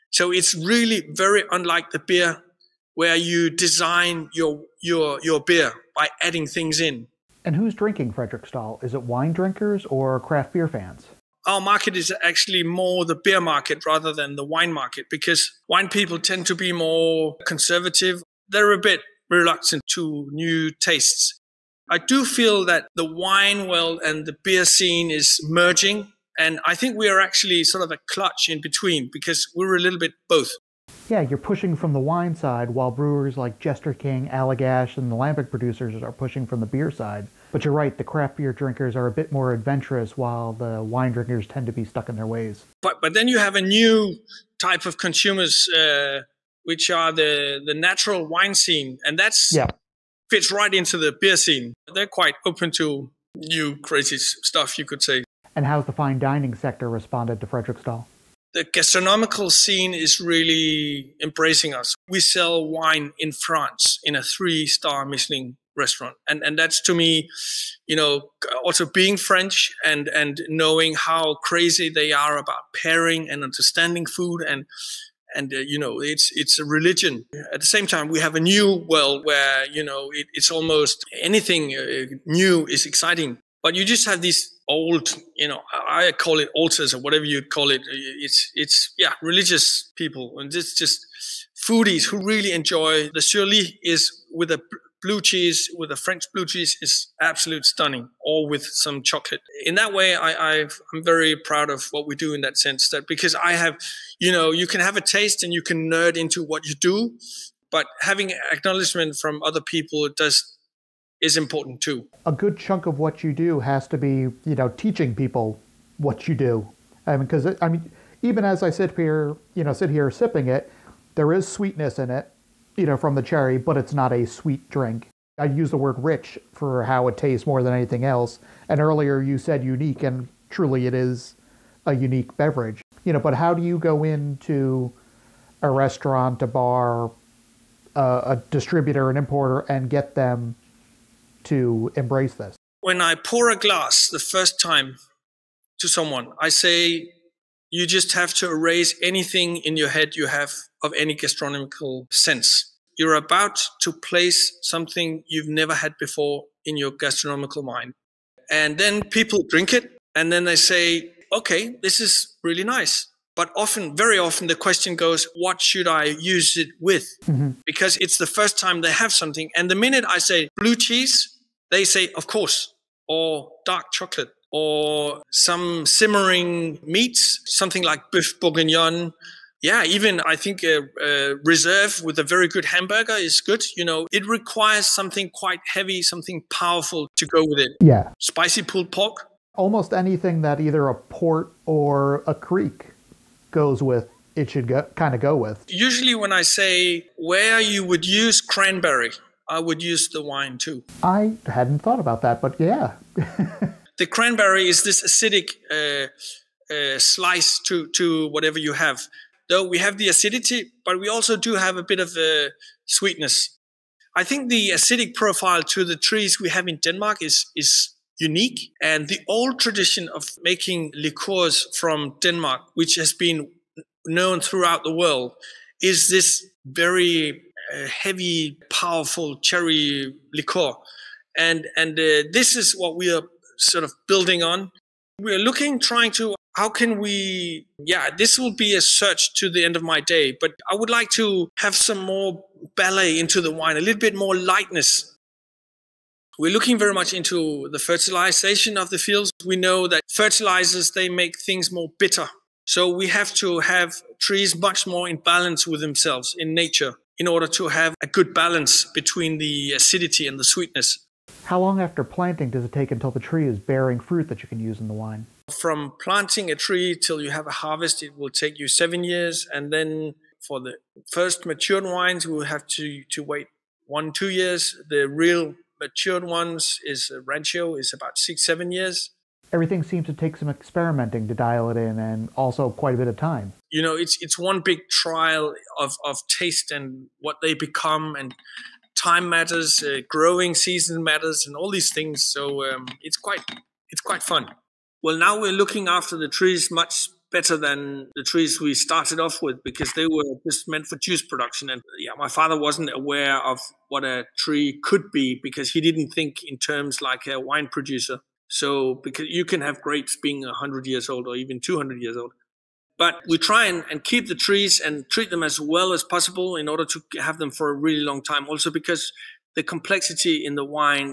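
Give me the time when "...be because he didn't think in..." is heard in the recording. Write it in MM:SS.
05:05.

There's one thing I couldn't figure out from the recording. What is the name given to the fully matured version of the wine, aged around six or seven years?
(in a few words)
rancio.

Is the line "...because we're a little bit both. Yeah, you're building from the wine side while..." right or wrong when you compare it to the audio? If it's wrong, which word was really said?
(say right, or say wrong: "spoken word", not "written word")
wrong: "pushing", not "building".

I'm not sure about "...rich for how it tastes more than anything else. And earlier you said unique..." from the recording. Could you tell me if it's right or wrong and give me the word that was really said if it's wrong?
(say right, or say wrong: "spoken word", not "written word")
right.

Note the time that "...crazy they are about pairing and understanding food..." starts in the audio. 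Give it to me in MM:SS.
01:11.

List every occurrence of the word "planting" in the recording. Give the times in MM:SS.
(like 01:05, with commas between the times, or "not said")
04:22, 04:26.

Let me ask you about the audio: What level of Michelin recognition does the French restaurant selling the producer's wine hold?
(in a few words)
three star.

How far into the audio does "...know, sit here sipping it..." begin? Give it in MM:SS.
01:59.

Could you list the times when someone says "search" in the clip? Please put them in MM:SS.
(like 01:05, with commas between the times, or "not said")
03:58.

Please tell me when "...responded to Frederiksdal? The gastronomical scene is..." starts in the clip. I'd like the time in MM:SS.
00:56.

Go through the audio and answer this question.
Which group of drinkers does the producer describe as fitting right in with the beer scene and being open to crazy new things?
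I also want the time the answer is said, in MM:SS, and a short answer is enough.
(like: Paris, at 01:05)
natural wine scene, at 00:47.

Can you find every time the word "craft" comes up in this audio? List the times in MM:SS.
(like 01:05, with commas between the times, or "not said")
00:10, 00:38.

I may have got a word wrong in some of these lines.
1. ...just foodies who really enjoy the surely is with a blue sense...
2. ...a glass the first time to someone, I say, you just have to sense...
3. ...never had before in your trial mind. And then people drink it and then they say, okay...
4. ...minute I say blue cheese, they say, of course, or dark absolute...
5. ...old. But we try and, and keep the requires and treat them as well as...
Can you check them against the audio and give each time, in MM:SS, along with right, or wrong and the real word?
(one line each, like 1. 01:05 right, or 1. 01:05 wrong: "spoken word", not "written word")
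1. 01:30 wrong: "cheese", not "sense"
2. 02:23 wrong: "erase", not "sense"
3. 02:35 wrong: "gastronomical", not "trial"
4. 02:49 wrong: "chocolate", not "absolute"
5. 05:12 wrong: "trees", not "requires".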